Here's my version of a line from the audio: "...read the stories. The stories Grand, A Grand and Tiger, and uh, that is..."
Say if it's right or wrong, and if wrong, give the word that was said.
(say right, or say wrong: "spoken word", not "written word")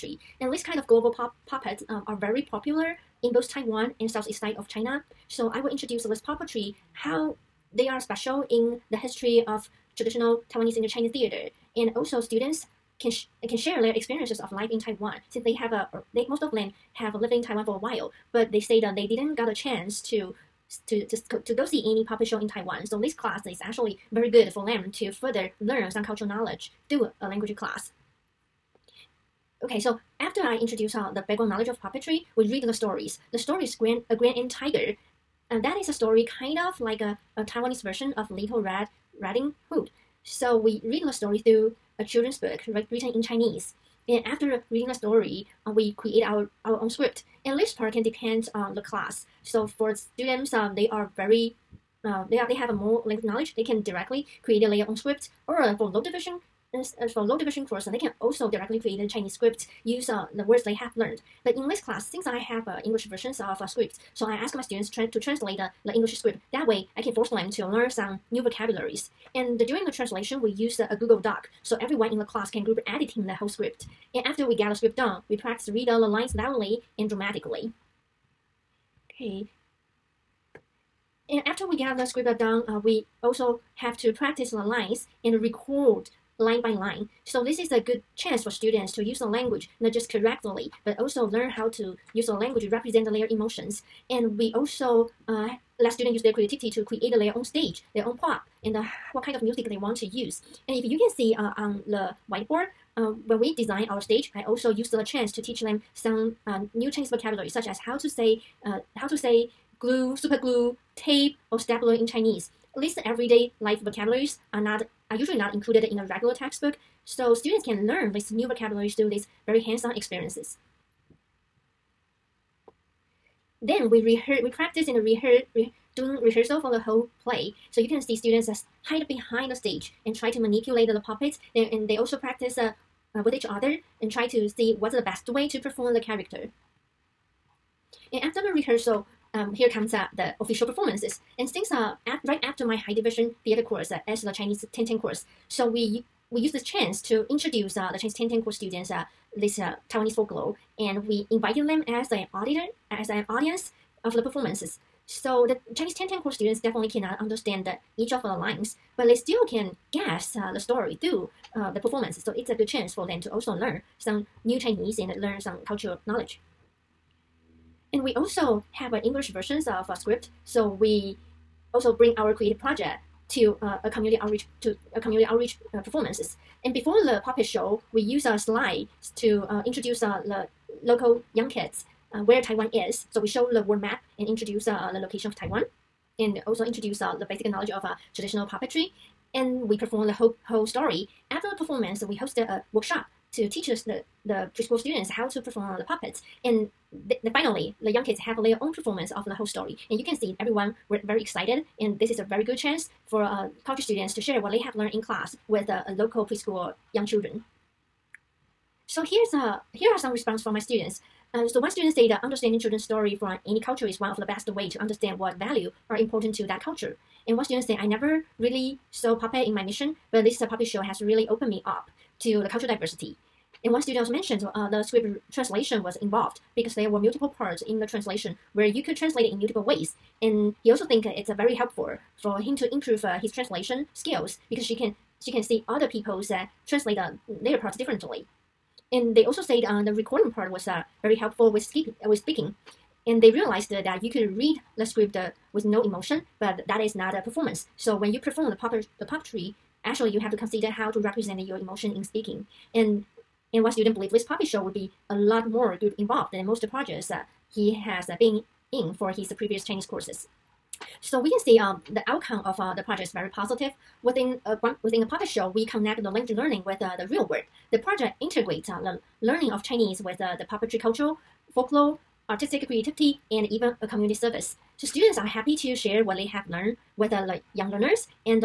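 right.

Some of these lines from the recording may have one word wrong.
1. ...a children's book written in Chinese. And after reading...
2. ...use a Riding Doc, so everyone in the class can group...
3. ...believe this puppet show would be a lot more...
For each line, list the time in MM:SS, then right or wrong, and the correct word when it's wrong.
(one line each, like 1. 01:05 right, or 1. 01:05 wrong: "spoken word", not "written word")
1. 00:41 right
2. 01:10 wrong: "Google", not "Riding"
3. 04:13 right.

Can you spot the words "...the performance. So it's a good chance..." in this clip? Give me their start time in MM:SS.
02:41.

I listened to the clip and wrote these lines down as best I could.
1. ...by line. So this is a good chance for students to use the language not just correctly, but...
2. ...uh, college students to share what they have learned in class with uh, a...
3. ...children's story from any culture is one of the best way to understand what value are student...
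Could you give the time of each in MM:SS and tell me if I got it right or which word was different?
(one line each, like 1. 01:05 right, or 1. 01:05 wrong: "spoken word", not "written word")
1. 01:26 right
2. 03:23 right
3. 03:32 wrong: "important", not "student".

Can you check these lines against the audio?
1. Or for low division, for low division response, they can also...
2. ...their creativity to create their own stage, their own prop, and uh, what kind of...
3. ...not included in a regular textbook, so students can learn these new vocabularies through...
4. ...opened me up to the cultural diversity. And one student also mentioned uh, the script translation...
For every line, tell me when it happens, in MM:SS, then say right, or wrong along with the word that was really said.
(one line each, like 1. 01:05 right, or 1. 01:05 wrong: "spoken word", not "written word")
1. 00:55 wrong: "course", not "response"
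2. 01:36 right
3. 01:55 right
4. 03:41 right.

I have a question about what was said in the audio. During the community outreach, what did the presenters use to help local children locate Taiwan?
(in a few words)
The world map.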